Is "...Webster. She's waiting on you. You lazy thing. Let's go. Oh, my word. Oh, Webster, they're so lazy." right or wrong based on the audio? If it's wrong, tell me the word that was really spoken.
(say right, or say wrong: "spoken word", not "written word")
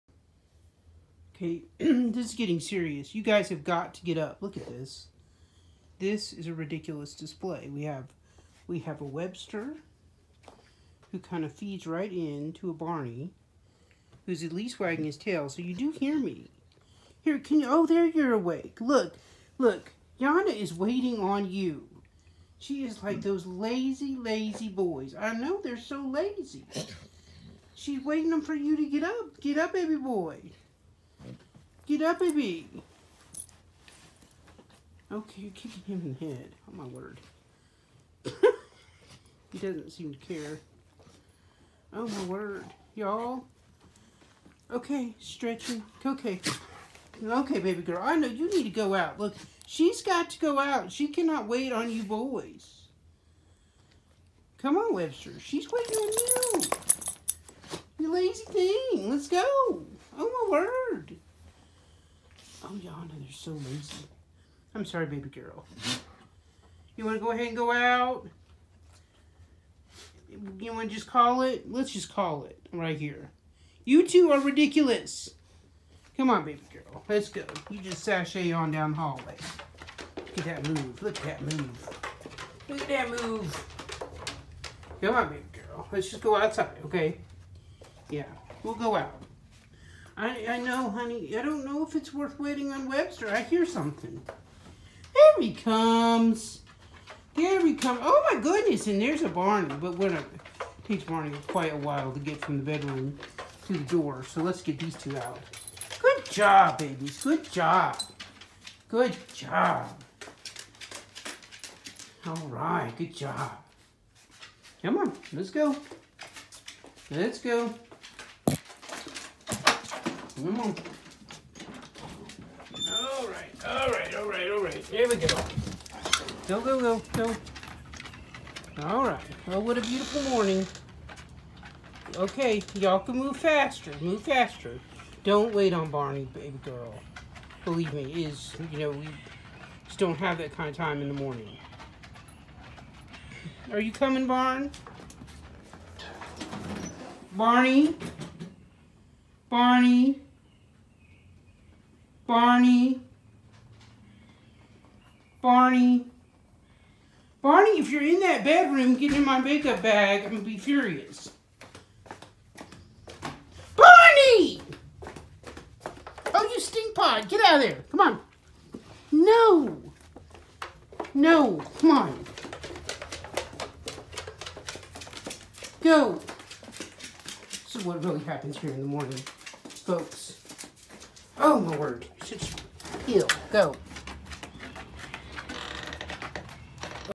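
wrong: "Yana", not "Webster".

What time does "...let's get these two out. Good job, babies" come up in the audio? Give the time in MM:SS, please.
01:44.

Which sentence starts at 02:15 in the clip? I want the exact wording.
Don't wait on Barney, baby girl.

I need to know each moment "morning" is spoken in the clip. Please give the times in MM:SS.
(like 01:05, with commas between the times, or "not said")
02:10, 02:21, 02:58.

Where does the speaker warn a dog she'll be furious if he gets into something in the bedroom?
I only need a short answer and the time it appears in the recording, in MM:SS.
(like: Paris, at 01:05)
Makeup bag, at 02:39.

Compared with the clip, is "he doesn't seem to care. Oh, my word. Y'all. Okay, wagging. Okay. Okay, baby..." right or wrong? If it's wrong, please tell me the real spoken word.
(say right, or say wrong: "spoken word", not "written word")
wrong: "stretching", not "wagging".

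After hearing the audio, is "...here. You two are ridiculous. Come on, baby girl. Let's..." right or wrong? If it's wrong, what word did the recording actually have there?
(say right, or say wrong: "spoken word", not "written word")
right.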